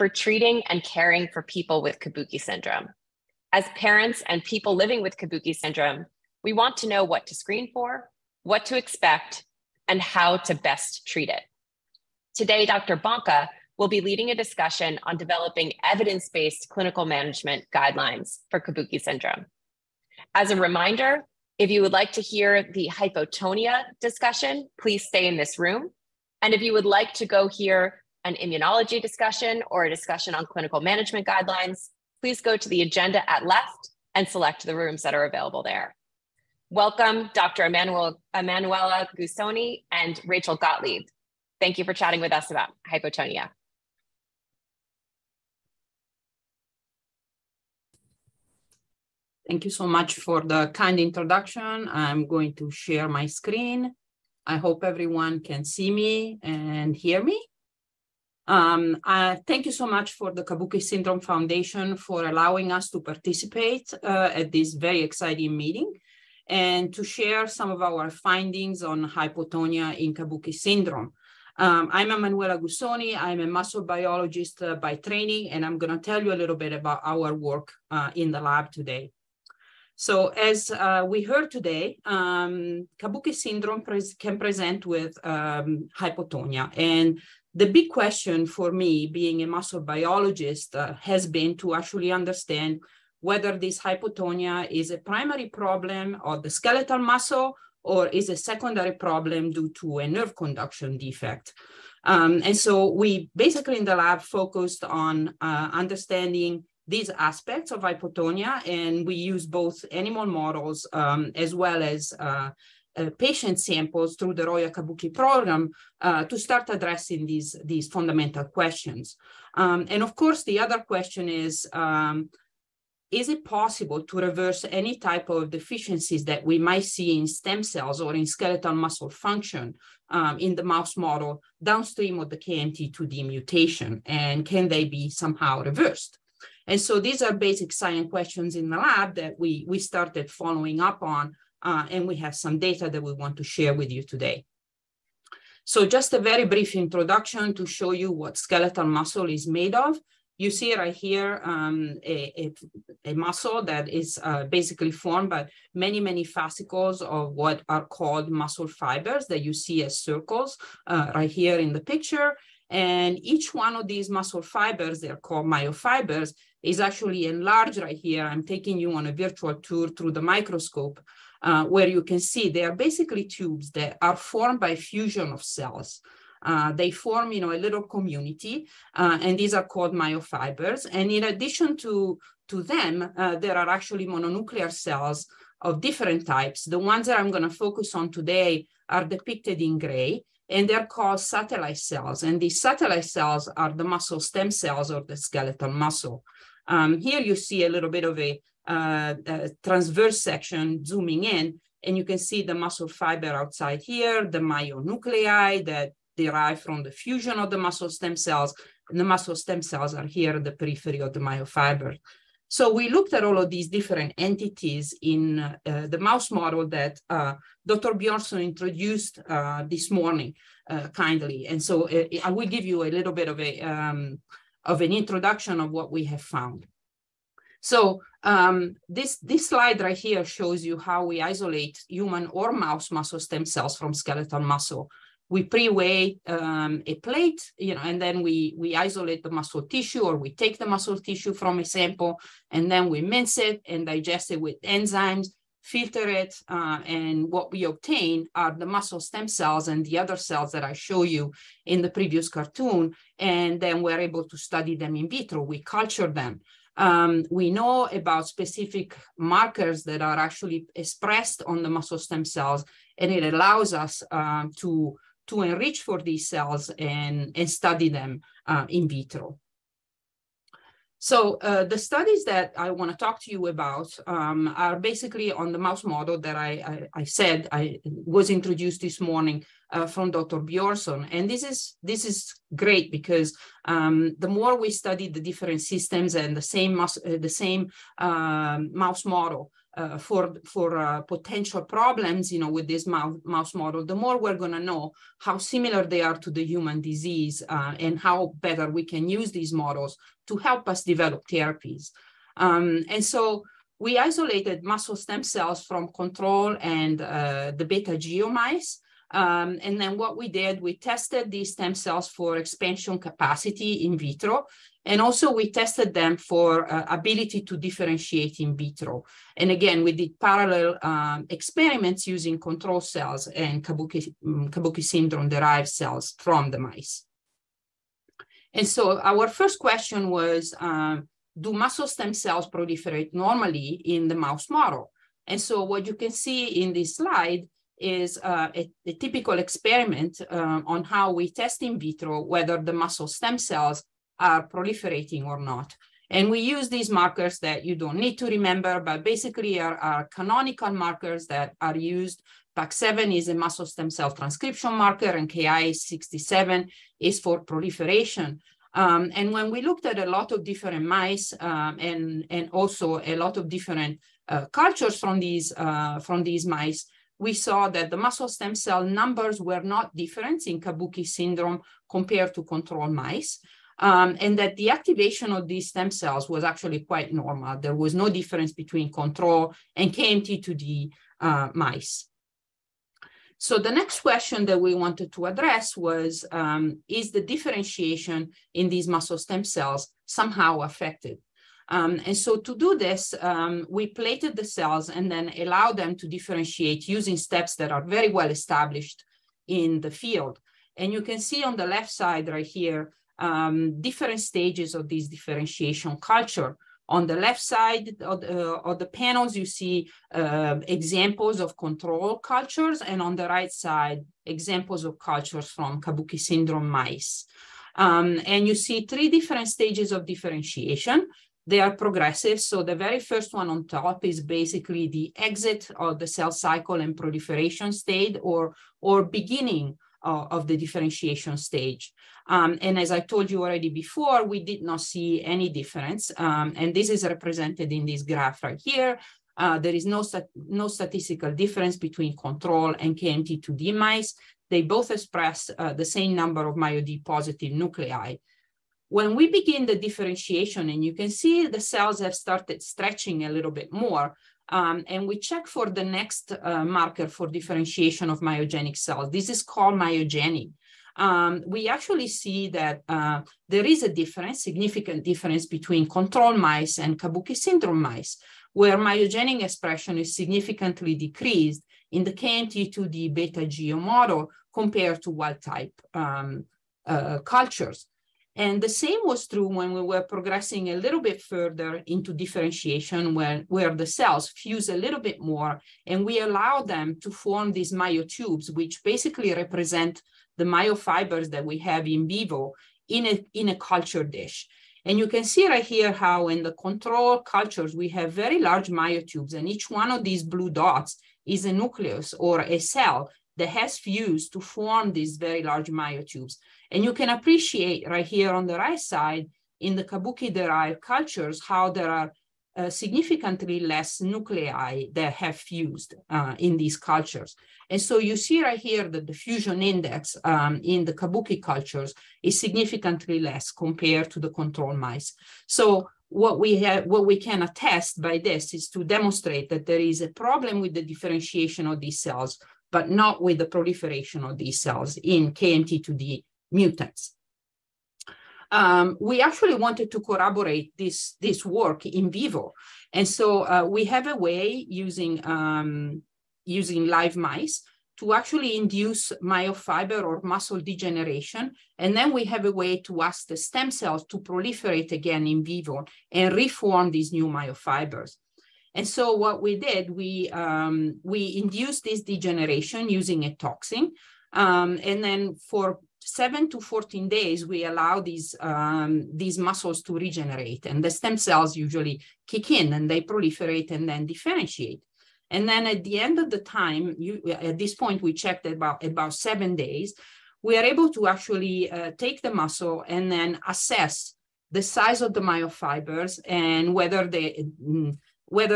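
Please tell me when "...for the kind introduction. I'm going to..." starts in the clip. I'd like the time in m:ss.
0:50.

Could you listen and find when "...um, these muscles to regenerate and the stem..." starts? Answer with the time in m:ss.
9:28.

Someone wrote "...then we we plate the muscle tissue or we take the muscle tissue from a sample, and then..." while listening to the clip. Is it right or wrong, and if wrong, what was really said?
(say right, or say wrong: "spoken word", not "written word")
wrong: "isolate", not "plate".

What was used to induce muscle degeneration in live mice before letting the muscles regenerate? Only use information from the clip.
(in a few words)
A toxin.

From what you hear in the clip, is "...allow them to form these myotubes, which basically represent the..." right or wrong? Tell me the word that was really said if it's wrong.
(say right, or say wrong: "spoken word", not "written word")
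right.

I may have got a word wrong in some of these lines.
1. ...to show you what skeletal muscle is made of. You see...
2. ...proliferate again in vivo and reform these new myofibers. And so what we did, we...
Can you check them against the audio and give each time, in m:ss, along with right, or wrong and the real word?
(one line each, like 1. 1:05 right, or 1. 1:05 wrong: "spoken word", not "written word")
1. 2:27 right
2. 9:14 right.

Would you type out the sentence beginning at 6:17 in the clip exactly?
There was no difference between control and KMT2D uh, mice.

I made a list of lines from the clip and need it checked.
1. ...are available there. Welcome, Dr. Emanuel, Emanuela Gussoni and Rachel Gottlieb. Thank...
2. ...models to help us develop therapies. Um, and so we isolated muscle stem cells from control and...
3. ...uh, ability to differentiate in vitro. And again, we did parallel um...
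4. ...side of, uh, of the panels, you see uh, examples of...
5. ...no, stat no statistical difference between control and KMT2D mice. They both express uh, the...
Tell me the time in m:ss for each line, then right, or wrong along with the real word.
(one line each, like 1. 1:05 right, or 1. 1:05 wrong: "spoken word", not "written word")
1. 0:35 right
2. 4:59 right
3. 5:16 right
4. 6:47 right
5. 7:19 right.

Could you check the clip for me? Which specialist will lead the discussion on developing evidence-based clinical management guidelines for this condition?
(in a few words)
Dr. Bonka.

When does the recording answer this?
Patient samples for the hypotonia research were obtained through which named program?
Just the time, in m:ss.
1:54.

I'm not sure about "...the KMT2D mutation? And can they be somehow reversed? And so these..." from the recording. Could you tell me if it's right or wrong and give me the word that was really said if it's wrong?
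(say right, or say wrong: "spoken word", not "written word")
right.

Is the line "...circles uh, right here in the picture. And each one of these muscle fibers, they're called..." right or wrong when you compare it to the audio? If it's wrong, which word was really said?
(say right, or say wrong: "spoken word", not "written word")
right.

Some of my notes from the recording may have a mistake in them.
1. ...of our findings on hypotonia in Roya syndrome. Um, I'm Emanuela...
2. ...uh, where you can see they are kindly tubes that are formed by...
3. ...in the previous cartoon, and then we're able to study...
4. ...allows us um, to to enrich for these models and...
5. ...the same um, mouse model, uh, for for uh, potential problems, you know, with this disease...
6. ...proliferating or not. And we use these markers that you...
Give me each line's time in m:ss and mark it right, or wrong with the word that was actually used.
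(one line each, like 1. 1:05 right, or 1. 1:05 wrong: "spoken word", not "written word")
1. 1:07 wrong: "Kabuki", not "Roya"
2. 2:51 wrong: "basically", not "kindly"
3. 4:11 right
4. 4:23 wrong: "cells", not "models"
5. 4:47 wrong: "mouse", not "disease"
6. 5:44 right.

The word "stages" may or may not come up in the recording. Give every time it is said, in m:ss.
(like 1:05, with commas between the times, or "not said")
6:44, 6:59, 7:11.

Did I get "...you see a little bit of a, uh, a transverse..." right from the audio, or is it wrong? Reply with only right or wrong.
right.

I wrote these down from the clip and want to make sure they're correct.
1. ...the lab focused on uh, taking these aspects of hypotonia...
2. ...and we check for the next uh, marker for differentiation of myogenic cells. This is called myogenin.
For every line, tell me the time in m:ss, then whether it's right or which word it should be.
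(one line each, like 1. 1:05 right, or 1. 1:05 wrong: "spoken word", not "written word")
1. 1:43 wrong: "understanding", not "taking"
2. 7:34 right.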